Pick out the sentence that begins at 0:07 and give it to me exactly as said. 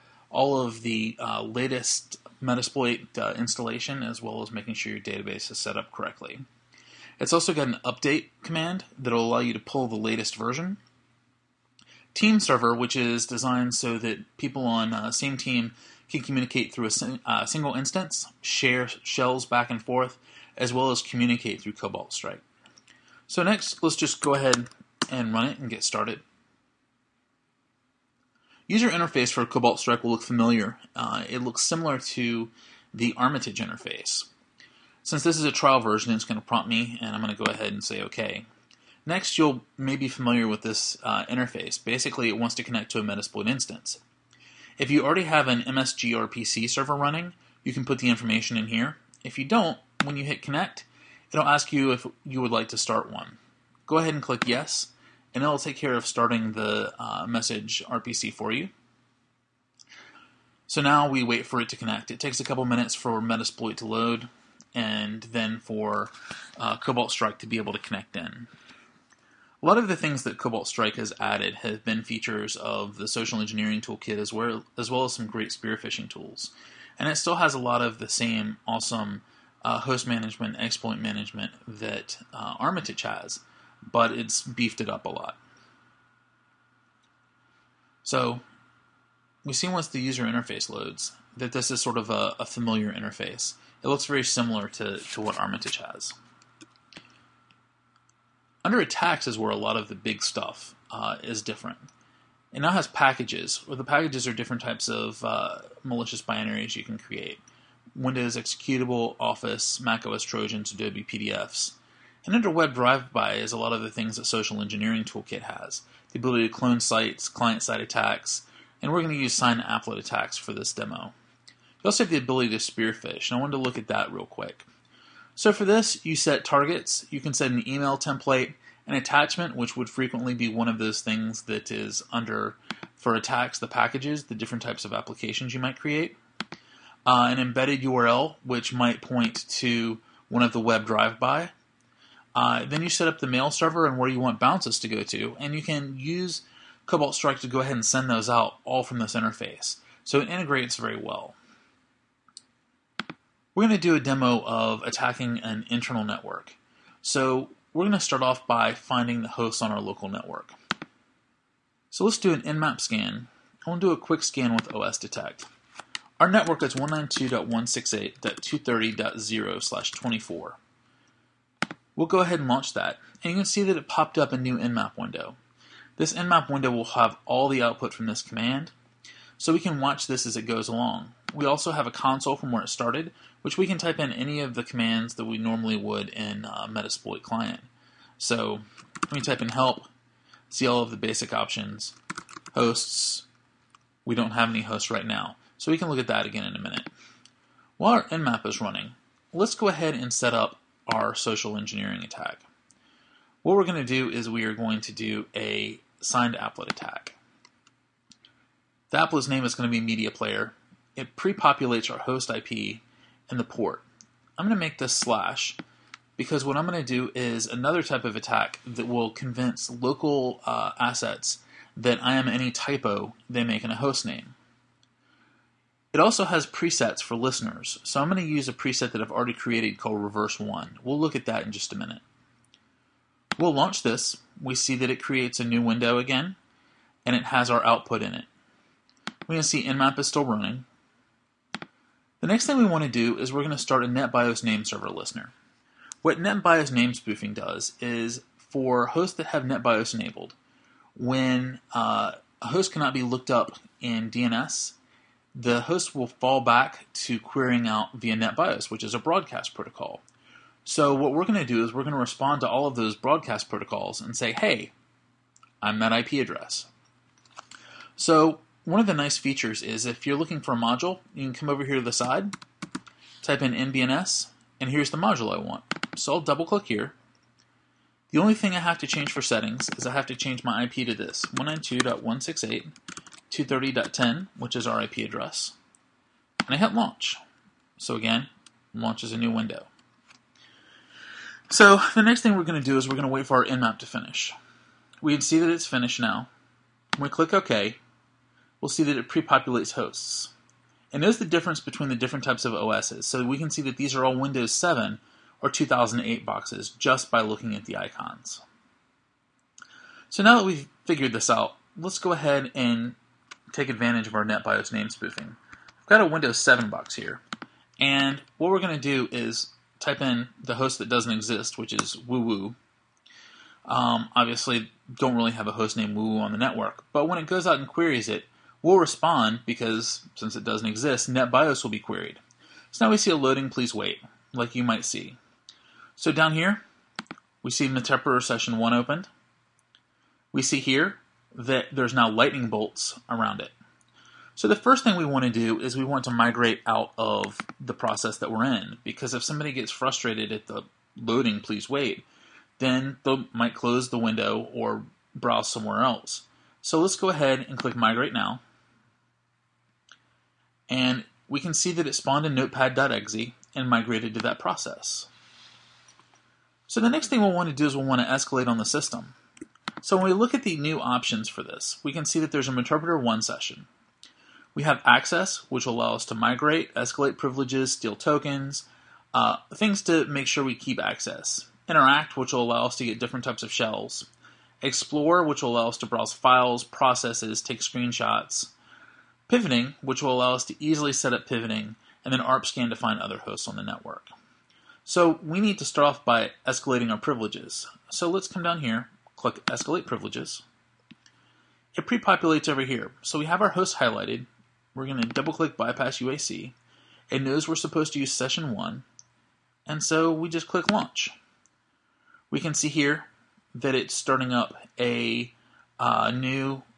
It's also got an update command that'll allow you to pull the latest version.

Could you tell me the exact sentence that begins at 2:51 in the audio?
We'll go ahead and launch that, and you can see that it popped up a new nmap window.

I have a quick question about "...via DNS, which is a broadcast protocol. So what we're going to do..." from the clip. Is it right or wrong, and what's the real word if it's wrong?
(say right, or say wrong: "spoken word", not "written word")
wrong: "NetBIOS", not "DNS".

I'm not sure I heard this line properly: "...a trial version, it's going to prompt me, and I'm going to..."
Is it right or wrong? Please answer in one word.
right.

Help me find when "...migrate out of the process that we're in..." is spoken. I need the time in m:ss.
5:46.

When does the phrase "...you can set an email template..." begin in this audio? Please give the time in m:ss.
2:07.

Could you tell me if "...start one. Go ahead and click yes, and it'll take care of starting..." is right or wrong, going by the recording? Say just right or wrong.
right.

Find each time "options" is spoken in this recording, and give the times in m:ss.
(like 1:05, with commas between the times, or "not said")
3:11, 6:10.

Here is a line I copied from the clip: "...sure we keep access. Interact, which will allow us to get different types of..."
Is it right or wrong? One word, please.
right.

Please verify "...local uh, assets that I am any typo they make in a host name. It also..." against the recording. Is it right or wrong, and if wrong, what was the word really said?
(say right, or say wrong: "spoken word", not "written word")
right.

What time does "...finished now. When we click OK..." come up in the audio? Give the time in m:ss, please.
4:55.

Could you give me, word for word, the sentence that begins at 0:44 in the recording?
If you already have an MSG or PC server running, you can put the information in here.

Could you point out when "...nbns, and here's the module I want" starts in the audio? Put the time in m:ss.
4:33.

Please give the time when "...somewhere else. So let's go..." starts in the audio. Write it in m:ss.
5:55.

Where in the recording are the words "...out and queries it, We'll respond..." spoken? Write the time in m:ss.
5:27.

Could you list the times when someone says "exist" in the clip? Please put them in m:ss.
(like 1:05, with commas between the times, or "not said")
5:21, 5:30.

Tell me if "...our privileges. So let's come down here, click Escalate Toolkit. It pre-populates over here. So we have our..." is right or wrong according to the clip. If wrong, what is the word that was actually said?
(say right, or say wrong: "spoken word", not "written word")
wrong: "Privileges", not "Toolkit".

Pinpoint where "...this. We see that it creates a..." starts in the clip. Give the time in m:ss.
3:53.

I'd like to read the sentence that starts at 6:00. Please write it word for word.
And we can see that it spawned in notepad.exe and migrated to that process.